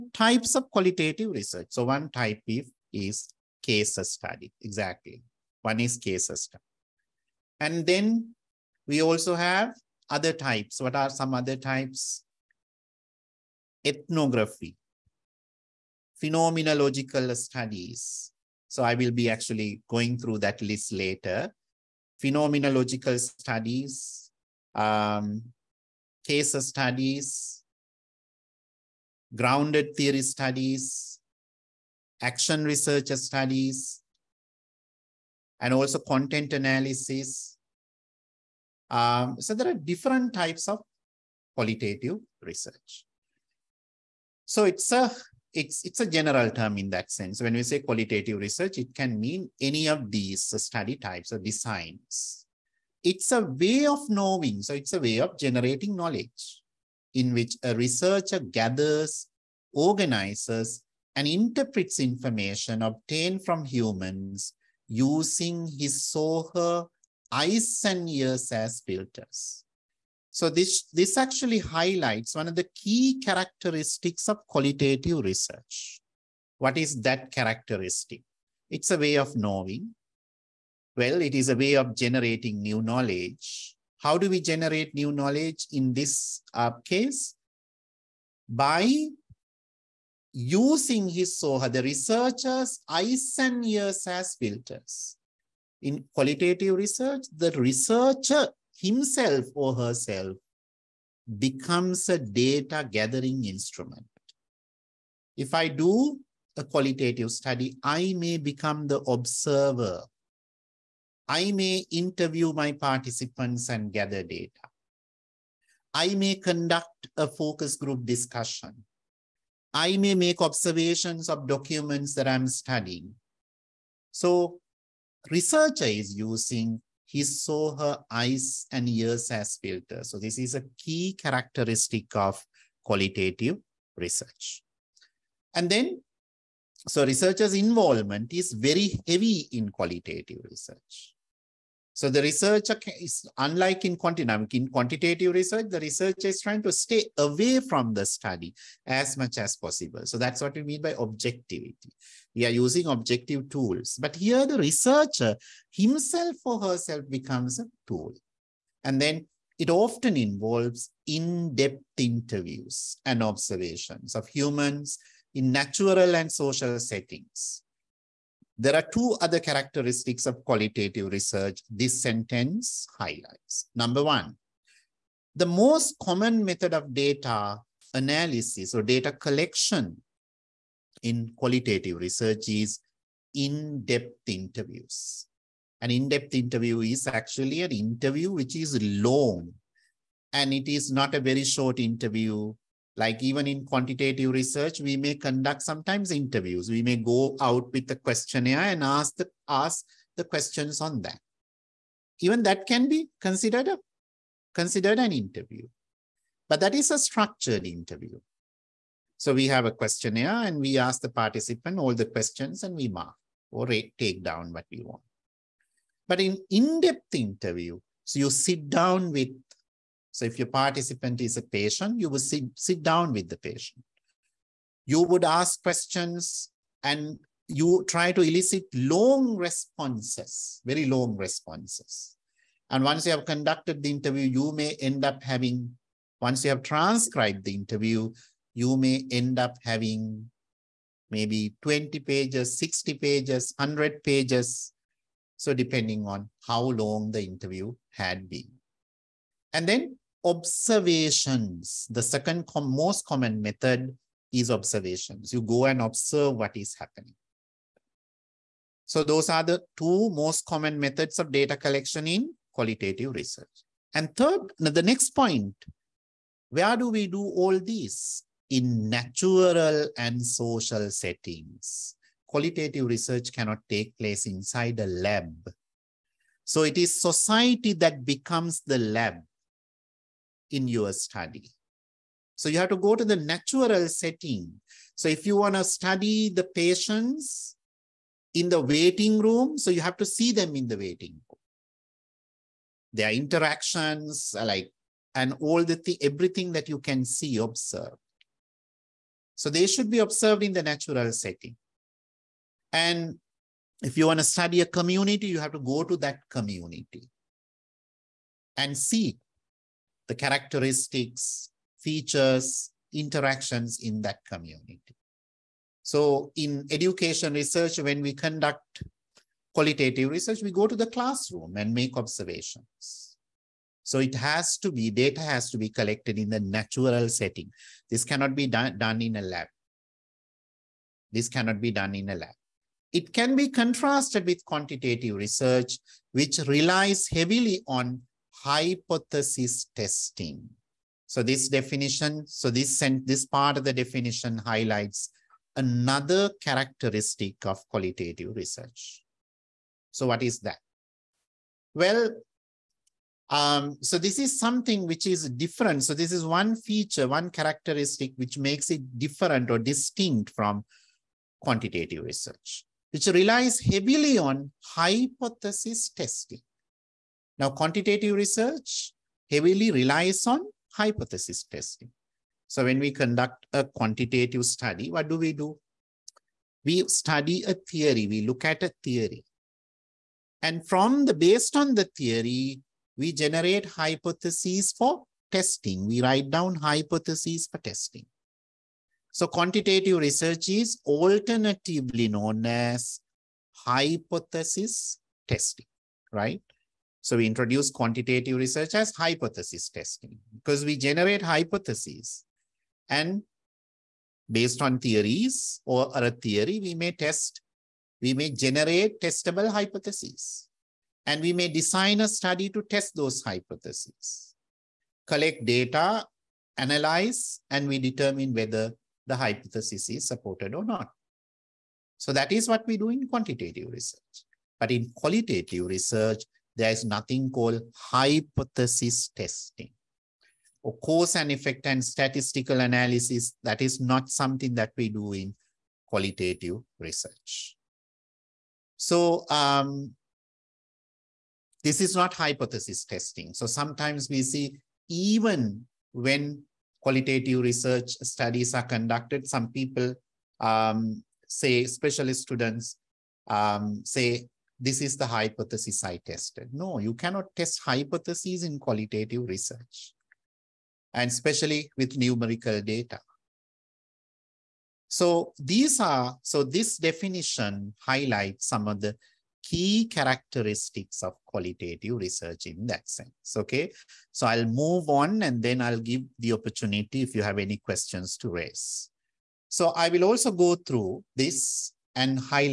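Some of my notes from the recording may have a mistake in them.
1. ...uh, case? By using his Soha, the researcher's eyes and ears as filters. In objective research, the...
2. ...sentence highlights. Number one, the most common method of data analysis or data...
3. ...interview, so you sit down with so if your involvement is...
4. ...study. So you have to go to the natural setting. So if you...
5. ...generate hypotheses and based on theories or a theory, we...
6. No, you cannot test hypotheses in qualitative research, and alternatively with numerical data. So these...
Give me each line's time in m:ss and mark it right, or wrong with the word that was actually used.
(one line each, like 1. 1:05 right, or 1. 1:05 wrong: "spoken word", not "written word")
1. 1:26 wrong: "qualitative", not "objective"
2. 2:52 right
3. 3:37 wrong: "participant", not "involvement"
4. 4:40 right
5. 6:40 right
6. 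7:36 wrong: "especially", not "alternatively".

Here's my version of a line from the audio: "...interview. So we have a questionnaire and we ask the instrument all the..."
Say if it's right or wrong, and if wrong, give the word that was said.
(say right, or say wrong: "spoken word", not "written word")
wrong: "participant", not "instrument".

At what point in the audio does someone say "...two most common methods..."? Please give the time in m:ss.
4:19.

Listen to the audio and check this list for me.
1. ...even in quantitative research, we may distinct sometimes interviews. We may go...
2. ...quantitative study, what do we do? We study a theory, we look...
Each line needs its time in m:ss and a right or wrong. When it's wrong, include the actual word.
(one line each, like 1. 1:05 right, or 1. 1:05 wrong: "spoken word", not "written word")
1. 3:13 wrong: "conduct", not "distinct"
2. 6:13 right.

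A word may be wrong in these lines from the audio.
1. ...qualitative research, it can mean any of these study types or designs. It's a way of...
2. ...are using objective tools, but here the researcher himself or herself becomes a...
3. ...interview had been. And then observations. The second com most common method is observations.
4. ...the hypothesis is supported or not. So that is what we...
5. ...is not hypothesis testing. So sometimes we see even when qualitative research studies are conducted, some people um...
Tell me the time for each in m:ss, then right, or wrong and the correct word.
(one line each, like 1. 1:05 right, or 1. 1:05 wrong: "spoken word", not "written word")
1. 0:47 right
2. 2:32 right
3. 4:07 right
4. 6:59 right
5. 7:21 right.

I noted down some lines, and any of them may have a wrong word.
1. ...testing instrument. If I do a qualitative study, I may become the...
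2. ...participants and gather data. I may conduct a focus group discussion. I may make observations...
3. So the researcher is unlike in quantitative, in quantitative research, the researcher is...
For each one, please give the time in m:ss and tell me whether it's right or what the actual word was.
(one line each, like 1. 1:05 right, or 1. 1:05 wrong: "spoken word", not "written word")
1. 1:42 wrong: "gathering", not "testing"
2. 1:52 right
3. 2:22 right.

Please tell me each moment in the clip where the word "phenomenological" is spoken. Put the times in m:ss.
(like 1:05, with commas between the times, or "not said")
0:16, 0:22.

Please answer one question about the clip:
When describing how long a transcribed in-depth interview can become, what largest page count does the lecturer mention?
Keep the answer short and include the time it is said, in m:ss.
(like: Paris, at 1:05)
100 pages, at 4:03.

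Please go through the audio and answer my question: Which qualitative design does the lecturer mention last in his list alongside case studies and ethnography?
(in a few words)
content analysis.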